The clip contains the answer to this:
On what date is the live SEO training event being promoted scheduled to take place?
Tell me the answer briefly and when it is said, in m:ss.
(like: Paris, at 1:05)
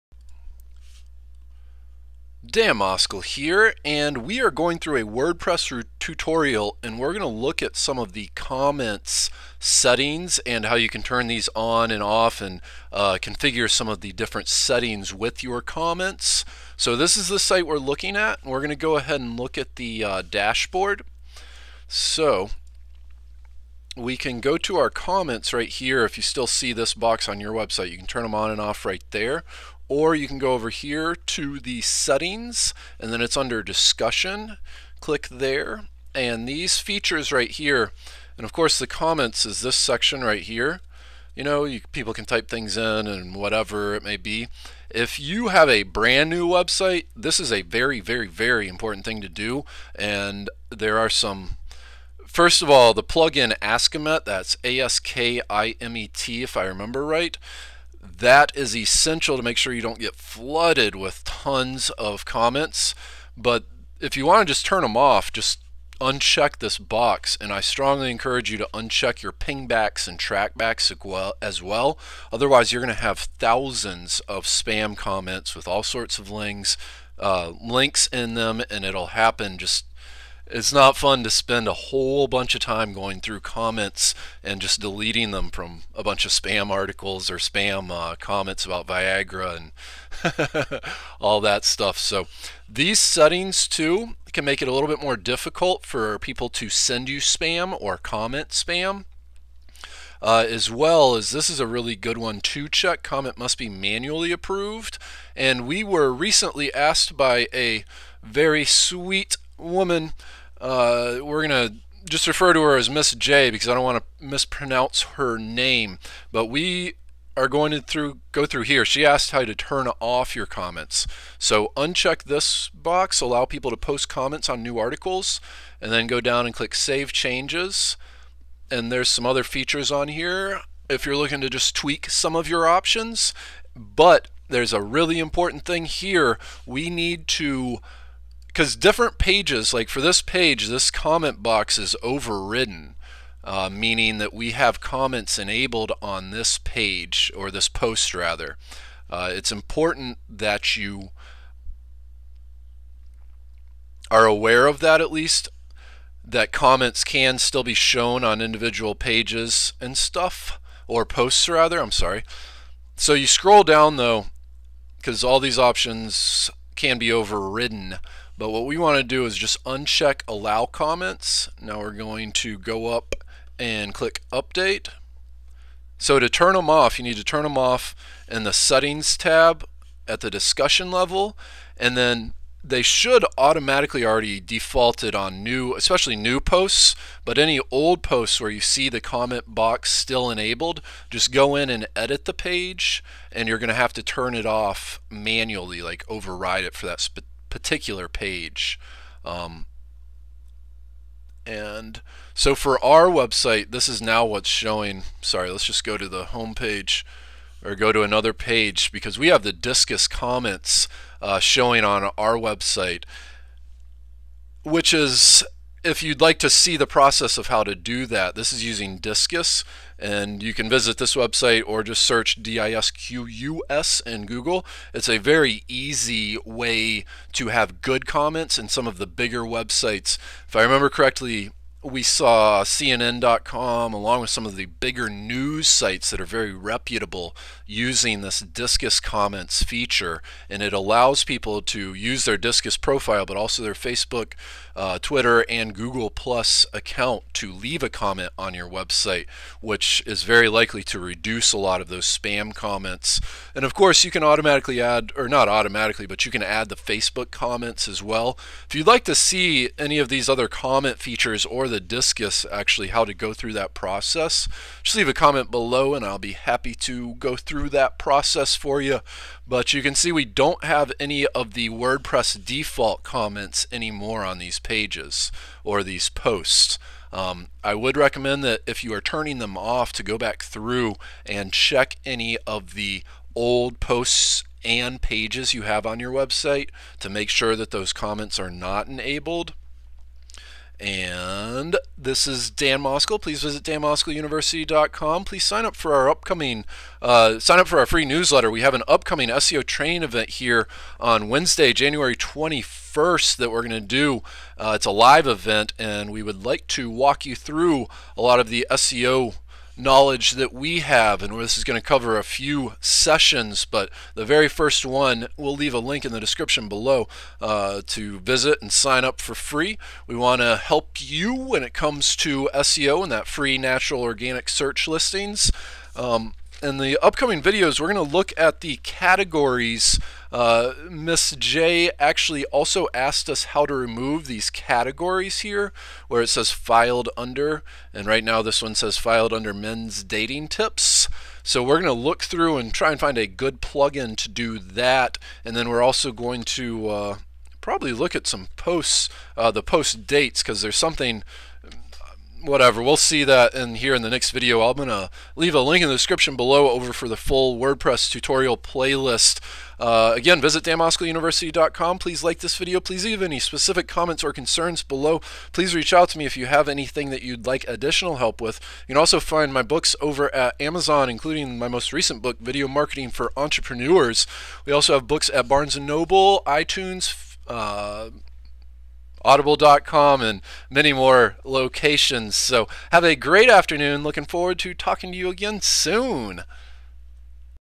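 Wednesday, January 21st, at 5:01.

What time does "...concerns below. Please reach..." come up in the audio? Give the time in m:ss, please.
6:04.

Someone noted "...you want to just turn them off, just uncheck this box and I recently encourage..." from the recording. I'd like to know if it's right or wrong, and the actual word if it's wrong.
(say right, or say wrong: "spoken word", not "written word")
wrong: "strongly", not "recently".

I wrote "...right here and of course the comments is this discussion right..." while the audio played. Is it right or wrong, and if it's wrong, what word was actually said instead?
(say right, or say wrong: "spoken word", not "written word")
wrong: "section", not "discussion".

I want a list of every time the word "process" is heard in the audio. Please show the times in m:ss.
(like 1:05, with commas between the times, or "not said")
3:36, 4:23, 4:27.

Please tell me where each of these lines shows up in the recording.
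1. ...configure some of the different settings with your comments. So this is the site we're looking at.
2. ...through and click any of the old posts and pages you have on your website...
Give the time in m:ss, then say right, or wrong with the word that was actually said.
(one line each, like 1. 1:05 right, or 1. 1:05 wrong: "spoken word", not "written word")
1. 0:13 right
2. 4:40 wrong: "check", not "click".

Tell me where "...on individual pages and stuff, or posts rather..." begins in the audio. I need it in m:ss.
2:38.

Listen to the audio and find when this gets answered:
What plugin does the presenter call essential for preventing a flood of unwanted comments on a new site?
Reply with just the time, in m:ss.
0:53.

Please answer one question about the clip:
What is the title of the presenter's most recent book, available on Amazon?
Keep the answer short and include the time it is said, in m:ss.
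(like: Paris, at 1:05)
Video Marketing for Entrepreneurs, at 6:12.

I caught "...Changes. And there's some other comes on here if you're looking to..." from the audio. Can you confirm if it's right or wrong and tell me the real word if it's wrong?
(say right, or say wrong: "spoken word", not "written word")
wrong: "features", not "comes".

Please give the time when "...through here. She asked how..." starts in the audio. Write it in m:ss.
1:58.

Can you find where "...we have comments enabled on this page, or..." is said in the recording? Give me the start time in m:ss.
2:24.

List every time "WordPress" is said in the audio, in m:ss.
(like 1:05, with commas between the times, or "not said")
0:05, 4:31, 5:57.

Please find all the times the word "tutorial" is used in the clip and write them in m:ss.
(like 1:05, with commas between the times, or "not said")
0:05, 5:58.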